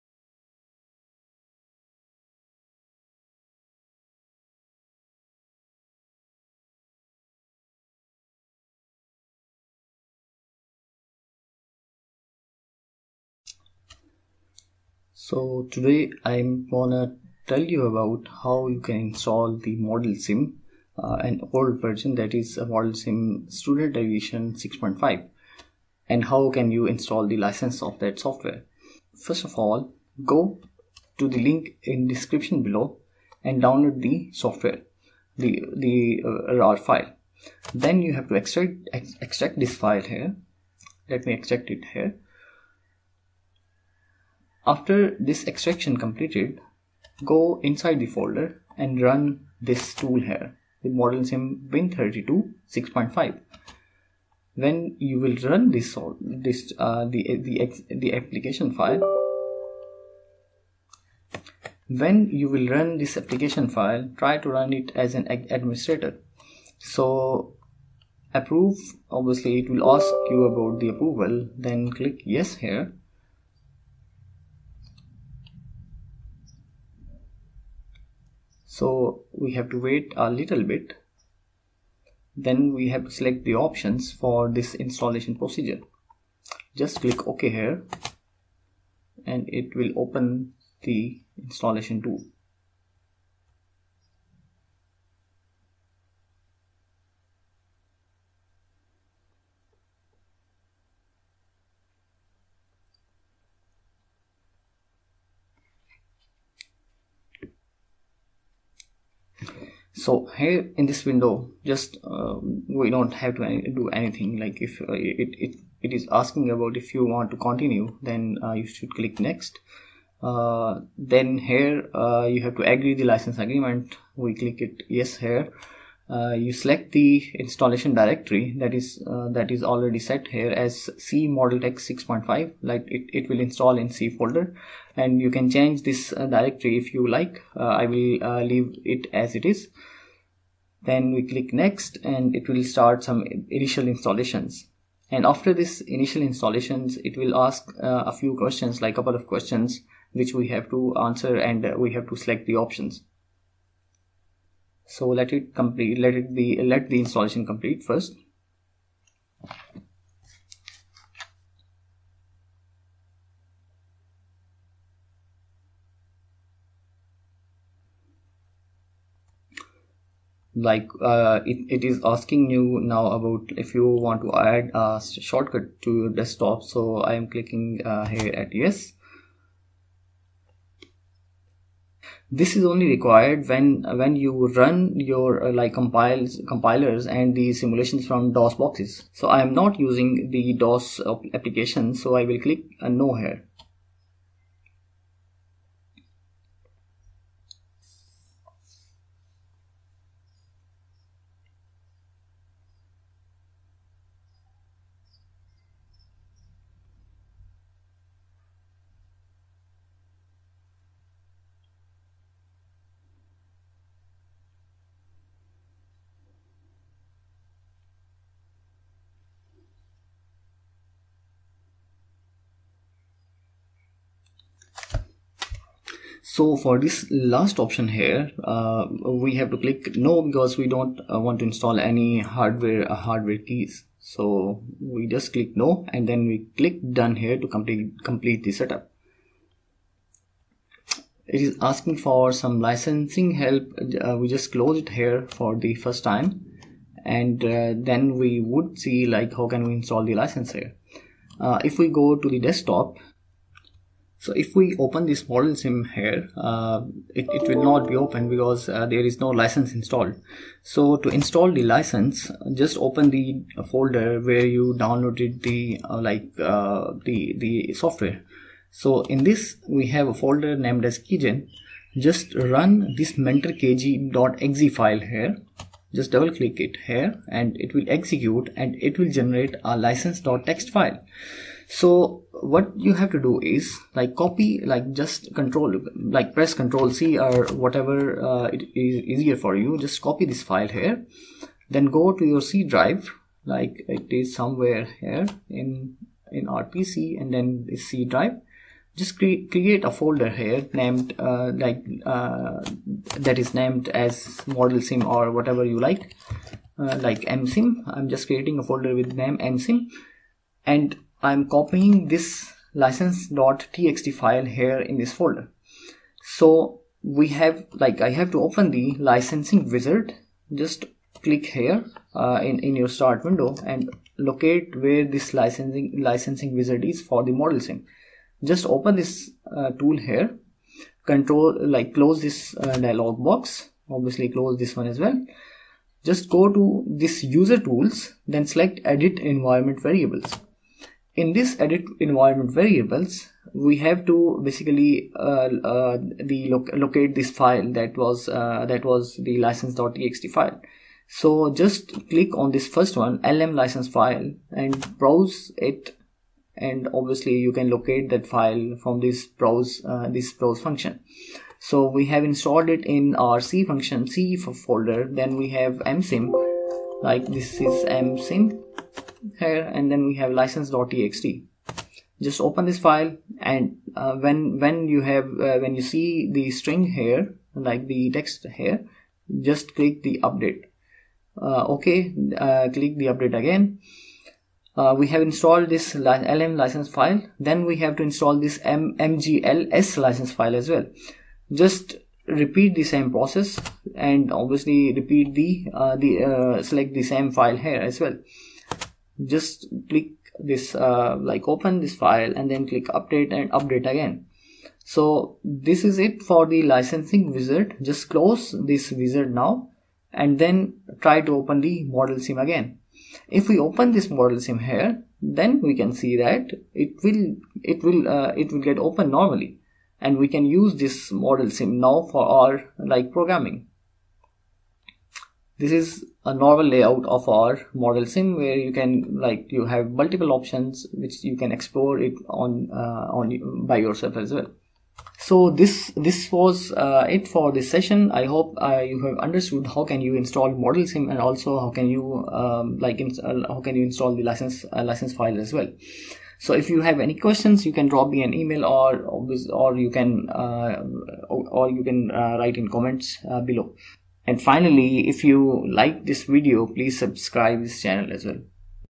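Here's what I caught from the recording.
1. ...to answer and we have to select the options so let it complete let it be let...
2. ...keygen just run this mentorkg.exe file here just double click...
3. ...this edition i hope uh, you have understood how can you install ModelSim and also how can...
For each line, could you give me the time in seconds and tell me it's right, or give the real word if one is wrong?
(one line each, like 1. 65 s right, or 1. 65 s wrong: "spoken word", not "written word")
1. 150 s right
2. 271 s right
3. 437 s wrong: "session", not "edition".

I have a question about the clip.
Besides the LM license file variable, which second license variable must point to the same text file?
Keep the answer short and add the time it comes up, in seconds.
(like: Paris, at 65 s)
MGLS license file, at 388 s.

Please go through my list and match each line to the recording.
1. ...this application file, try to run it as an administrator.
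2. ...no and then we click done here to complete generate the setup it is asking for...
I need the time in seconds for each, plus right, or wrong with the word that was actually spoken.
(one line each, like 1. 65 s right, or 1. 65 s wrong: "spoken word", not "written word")
1. 62 s right
2. 235 s wrong: "complete", not "generate".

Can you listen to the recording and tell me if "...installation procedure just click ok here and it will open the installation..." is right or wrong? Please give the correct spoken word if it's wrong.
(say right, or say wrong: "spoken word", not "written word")
right.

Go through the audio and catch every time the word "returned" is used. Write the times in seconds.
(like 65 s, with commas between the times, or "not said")
not said.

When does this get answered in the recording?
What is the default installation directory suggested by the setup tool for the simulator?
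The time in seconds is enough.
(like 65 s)
130 s.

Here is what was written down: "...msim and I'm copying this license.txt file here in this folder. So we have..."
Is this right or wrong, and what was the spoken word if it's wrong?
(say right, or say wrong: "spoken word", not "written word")
right.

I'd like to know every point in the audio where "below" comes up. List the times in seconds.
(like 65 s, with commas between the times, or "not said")
32 s, 453 s.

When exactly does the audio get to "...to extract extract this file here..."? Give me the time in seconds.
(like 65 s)
38 s.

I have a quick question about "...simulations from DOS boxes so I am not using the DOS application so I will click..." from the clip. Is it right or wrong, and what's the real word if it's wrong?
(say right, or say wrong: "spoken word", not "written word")
right.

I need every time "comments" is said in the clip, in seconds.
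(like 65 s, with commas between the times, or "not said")
452 s.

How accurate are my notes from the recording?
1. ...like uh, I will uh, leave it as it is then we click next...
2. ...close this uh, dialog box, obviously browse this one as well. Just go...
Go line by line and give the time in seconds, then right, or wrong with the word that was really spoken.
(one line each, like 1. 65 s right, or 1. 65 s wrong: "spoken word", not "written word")
1. 137 s right
2. 331 s wrong: "close", not "browse".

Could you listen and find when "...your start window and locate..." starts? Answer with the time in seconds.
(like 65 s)
322 s.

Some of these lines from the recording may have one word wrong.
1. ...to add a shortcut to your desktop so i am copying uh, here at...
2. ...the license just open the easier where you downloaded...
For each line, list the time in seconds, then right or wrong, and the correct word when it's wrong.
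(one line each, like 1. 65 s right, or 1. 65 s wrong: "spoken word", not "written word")
1. 174 s wrong: "clicking", not "copying"
2. 261 s wrong: "folder", not "easier".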